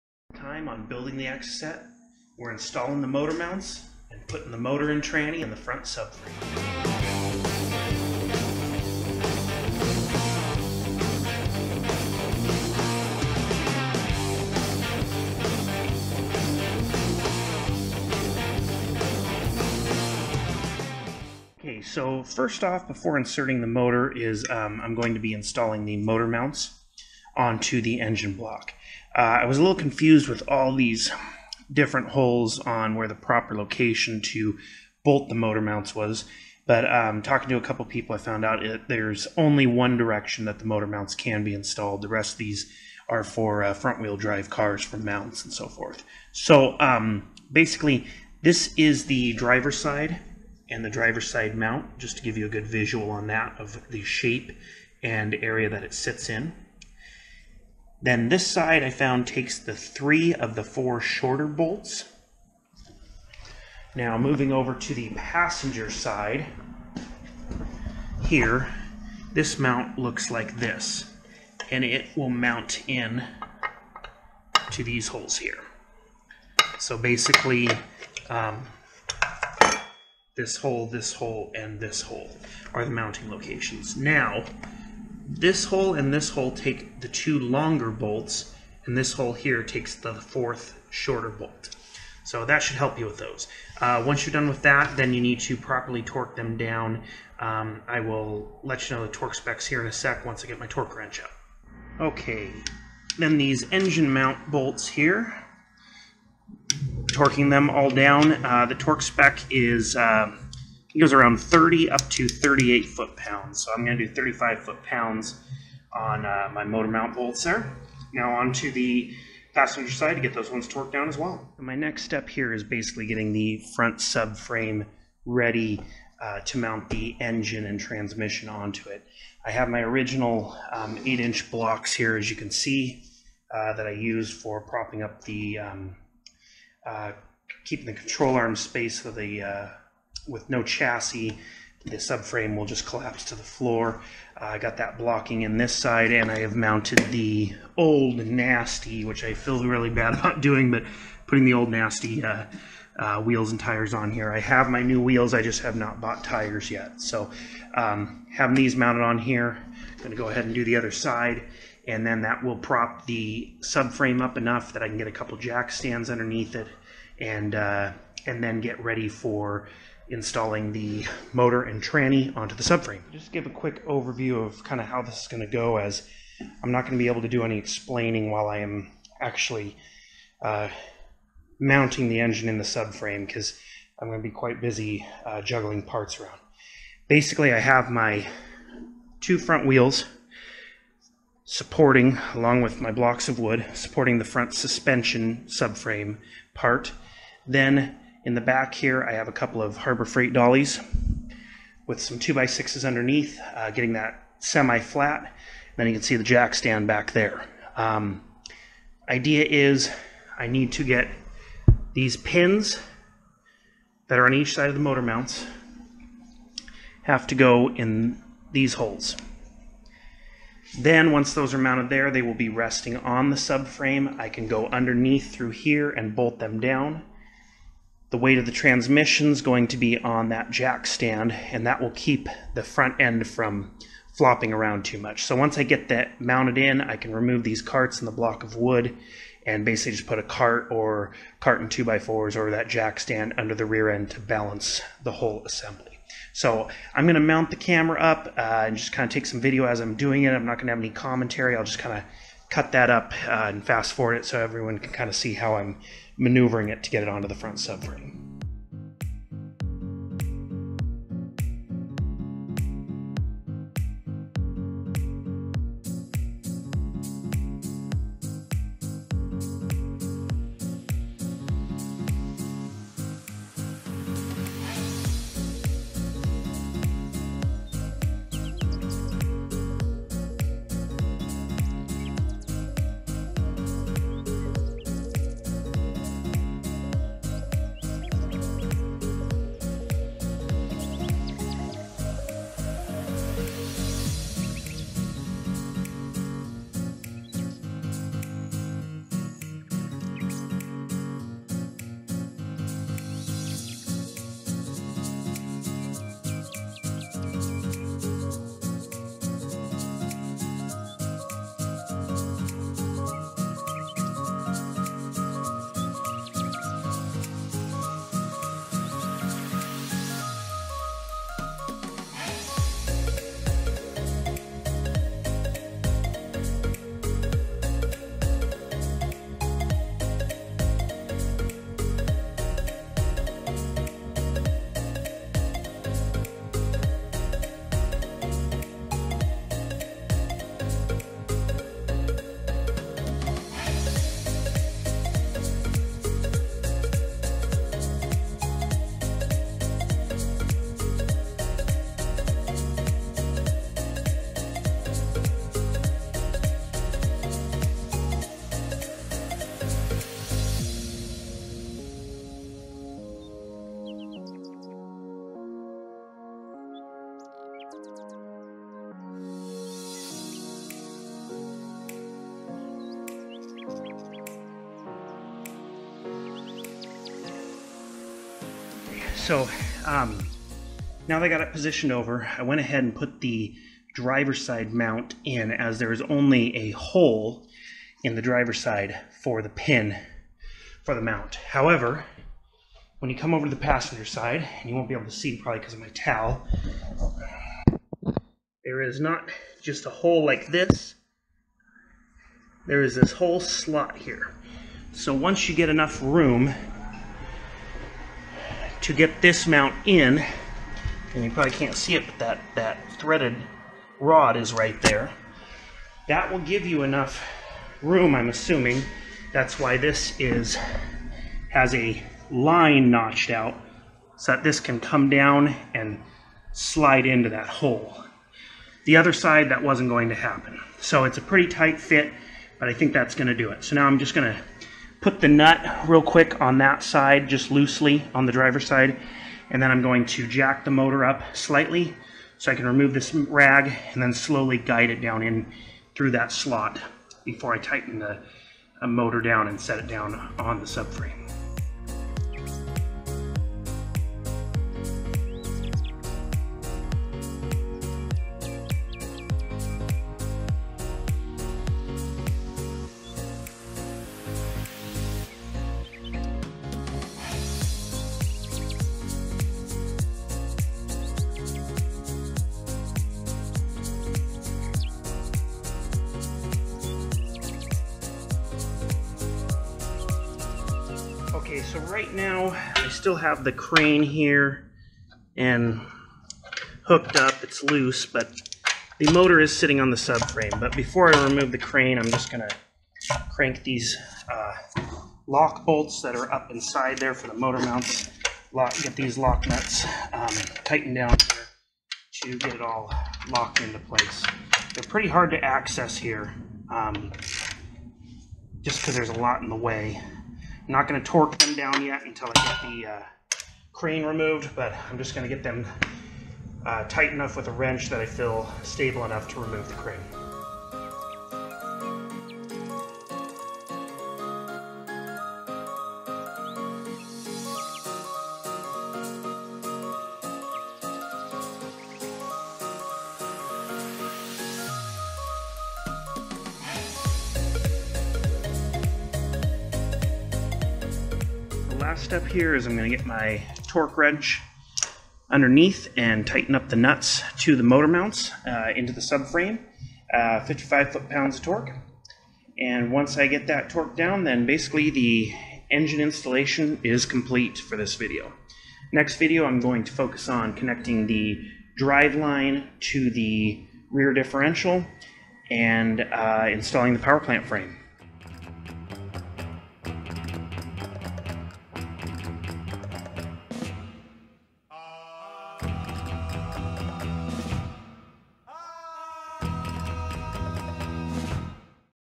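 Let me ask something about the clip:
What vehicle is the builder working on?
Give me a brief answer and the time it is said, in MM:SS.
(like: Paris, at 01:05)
Exocet, at 00:01.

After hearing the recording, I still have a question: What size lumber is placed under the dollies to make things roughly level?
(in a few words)
2x6.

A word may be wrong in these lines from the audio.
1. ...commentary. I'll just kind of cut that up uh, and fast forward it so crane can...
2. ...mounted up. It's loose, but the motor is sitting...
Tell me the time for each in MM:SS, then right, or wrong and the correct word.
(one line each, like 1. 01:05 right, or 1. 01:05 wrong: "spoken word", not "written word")
1. 04:10 wrong: "everyone", not "crane"
2. 08:06 wrong: "hooked", not "mounted".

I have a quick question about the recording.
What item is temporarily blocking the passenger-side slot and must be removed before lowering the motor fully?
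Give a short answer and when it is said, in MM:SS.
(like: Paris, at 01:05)
rag, at 07:23.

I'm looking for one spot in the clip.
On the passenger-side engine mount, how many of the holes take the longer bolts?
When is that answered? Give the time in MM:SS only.
01:27.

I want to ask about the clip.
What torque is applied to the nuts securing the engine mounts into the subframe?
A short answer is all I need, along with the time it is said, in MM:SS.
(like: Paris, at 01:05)
55 foot-pounds, at 09:10.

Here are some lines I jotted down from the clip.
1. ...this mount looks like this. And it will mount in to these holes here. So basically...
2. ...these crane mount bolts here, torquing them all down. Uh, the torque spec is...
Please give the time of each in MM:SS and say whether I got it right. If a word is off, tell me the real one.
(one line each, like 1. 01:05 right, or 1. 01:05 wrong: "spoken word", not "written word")
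1. 01:09 right
2. 01:43 wrong: "engine", not "crane".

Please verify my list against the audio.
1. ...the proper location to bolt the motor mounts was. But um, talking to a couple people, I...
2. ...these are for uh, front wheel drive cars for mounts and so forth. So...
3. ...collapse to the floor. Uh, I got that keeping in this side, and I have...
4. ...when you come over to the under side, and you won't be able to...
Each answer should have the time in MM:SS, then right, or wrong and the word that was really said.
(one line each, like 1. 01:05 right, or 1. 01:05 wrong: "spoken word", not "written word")
1. 00:33 right
2. 00:42 right
3. 02:22 wrong: "blocking", not "keeping"
4. 06:32 wrong: "passenger", not "under".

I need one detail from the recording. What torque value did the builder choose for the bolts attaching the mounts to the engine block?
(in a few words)
35 foot pounds.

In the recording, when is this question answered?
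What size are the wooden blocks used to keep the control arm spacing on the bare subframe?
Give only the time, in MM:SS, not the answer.
02:11.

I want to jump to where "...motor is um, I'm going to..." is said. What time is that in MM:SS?
00:23.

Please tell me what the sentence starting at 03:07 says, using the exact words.
Basically, I have my two front wheels supporting, along with my blocks of wood, supporting the front suspension subframe part.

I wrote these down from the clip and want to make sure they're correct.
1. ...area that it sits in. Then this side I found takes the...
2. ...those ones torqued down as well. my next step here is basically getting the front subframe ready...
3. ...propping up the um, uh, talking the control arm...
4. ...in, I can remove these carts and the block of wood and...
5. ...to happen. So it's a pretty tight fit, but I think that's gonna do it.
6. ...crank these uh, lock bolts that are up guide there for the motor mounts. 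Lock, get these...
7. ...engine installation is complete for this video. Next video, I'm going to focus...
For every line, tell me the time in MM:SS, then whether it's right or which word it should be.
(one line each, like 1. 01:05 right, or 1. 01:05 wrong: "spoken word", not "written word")
1. 00:55 right
2. 02:00 right
3. 02:14 wrong: "keeping", not "talking"
4. 03:56 right
5. 07:10 right
6. 08:13 wrong: "inside", not "guide"
7. 09:15 right.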